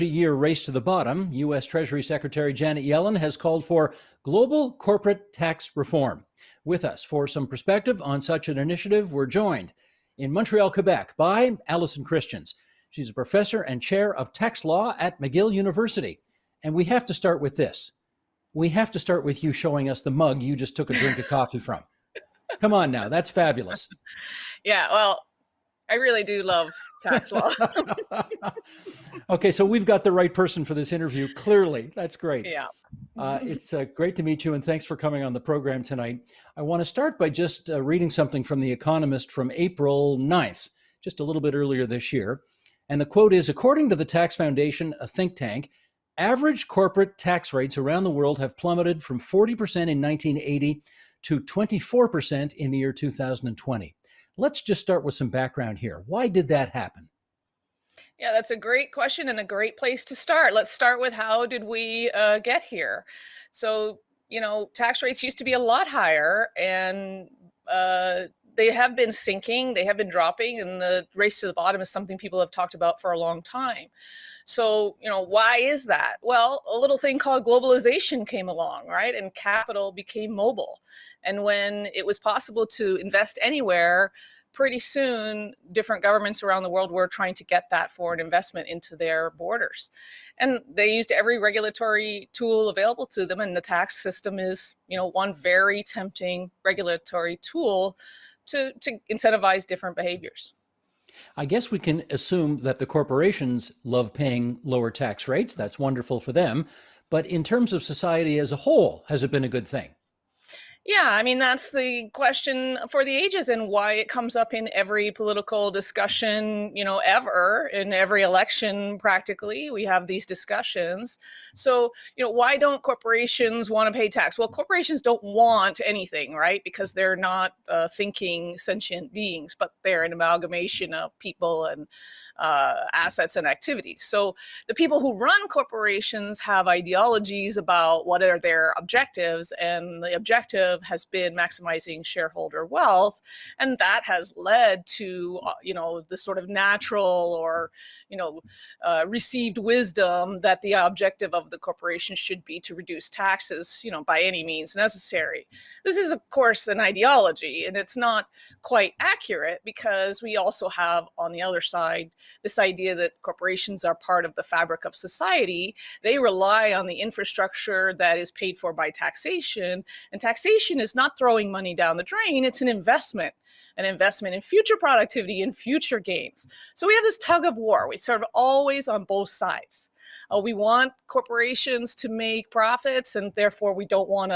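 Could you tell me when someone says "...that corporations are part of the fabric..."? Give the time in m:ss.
2:42.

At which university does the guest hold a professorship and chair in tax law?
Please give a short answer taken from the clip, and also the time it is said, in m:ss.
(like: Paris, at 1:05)
McGill University, at 0:15.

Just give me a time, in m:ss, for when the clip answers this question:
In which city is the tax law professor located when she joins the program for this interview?
0:10.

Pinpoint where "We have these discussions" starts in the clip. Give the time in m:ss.
1:59.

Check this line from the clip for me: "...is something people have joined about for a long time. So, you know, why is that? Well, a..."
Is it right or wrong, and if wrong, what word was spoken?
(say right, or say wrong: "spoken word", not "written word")
wrong: "talked", not "joined".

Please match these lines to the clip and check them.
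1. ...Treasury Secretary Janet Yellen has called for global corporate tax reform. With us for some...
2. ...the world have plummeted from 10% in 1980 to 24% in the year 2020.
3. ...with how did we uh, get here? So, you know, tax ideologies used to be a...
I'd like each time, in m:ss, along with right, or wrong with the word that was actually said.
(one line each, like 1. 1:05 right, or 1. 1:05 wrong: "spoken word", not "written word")
1. 0:01 right
2. 0:48 wrong: "40", not "10"
3. 1:00 wrong: "rates", not "ideologies".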